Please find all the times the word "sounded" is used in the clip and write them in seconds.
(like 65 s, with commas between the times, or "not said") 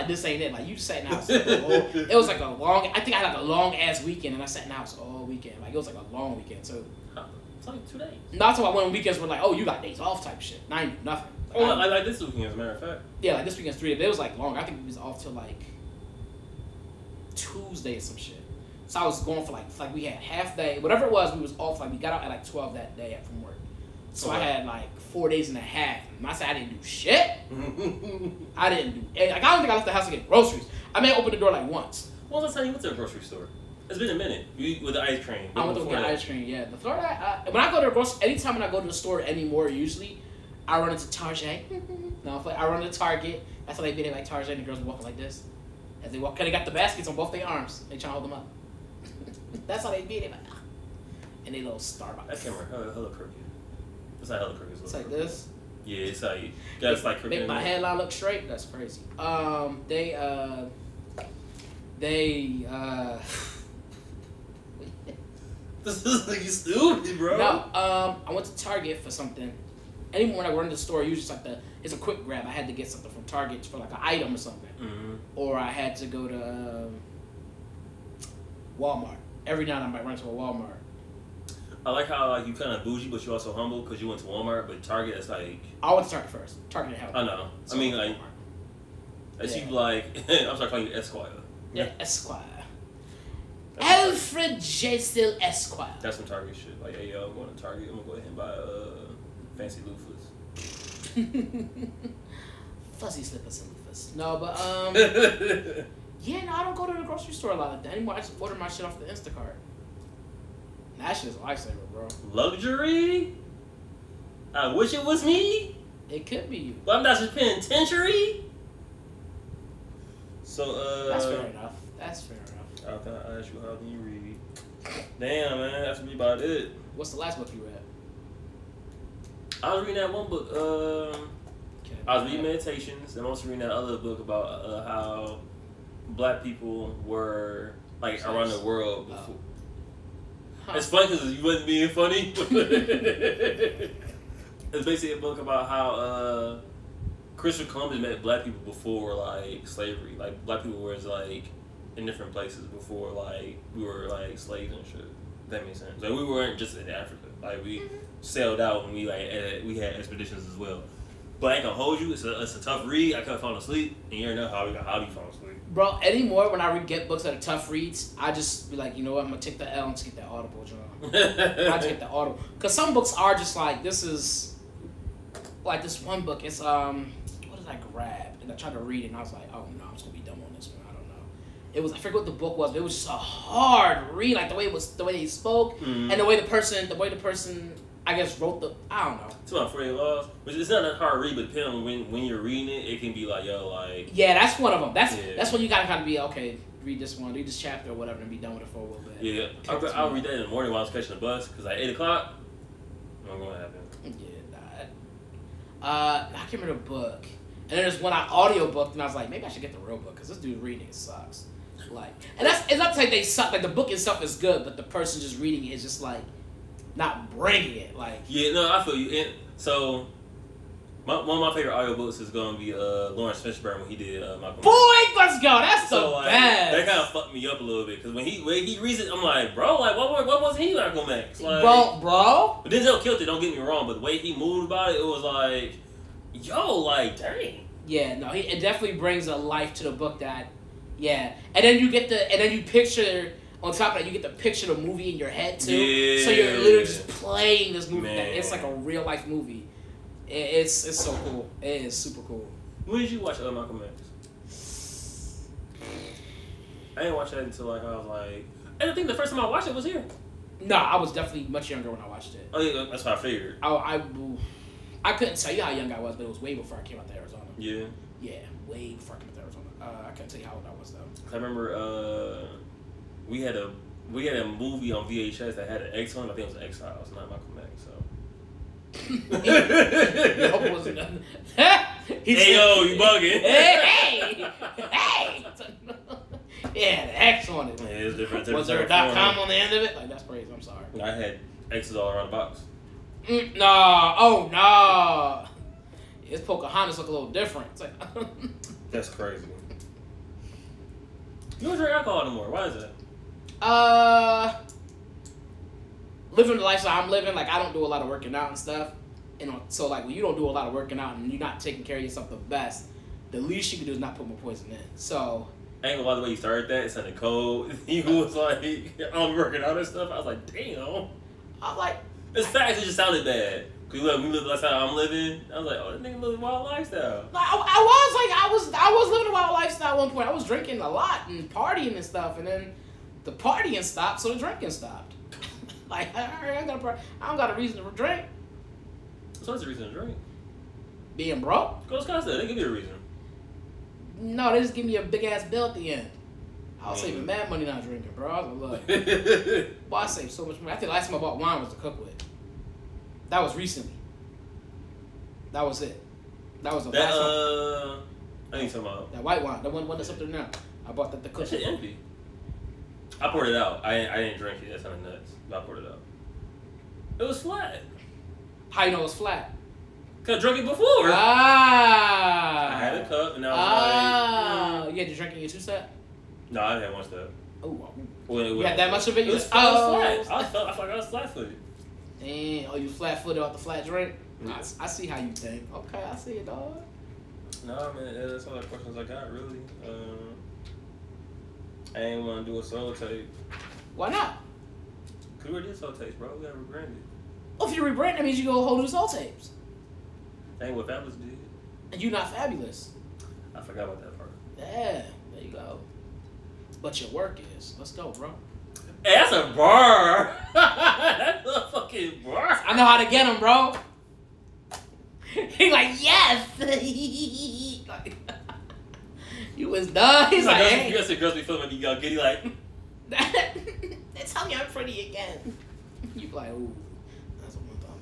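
316 s, 322 s.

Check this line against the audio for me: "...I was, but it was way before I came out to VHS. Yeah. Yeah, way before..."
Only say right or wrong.
wrong.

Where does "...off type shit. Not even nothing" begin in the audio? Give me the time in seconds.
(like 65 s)
9 s.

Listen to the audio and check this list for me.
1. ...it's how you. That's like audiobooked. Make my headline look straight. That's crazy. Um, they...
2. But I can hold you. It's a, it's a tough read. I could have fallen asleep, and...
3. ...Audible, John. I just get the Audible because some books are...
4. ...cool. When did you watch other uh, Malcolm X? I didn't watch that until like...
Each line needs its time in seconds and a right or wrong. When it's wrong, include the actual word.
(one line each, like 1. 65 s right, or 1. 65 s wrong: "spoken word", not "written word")
1. 55 s wrong: "crooked", not "audiobooked"
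2. 161 s right
3. 170 s right
4. 252 s right.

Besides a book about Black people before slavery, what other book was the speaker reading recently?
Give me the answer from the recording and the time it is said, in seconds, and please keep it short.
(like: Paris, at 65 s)
Meditations, at 132 s.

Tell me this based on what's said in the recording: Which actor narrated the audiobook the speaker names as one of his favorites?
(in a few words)
Laurence Fishburne.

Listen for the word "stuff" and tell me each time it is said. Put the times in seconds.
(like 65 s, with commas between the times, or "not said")
308 s, 319 s, 332 s.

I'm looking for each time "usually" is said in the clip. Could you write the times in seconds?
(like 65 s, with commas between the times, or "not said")
39 s, 71 s.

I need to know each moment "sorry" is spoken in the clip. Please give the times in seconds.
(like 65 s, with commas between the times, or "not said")
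90 s, 290 s.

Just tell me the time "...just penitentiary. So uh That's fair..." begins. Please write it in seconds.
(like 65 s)
117 s.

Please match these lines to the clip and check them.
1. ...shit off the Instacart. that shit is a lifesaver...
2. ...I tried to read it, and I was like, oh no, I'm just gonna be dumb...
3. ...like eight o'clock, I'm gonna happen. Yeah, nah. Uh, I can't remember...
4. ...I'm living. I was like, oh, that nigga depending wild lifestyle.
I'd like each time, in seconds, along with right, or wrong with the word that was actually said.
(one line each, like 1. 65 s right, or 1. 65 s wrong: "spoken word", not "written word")
1. 108 s right
2. 178 s right
3. 201 s right
4. 324 s wrong: "living", not "depending".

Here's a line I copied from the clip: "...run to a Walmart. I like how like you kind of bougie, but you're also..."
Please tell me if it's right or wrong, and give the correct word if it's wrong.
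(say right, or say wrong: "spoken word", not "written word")
right.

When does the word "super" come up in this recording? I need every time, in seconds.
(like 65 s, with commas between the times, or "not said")
251 s.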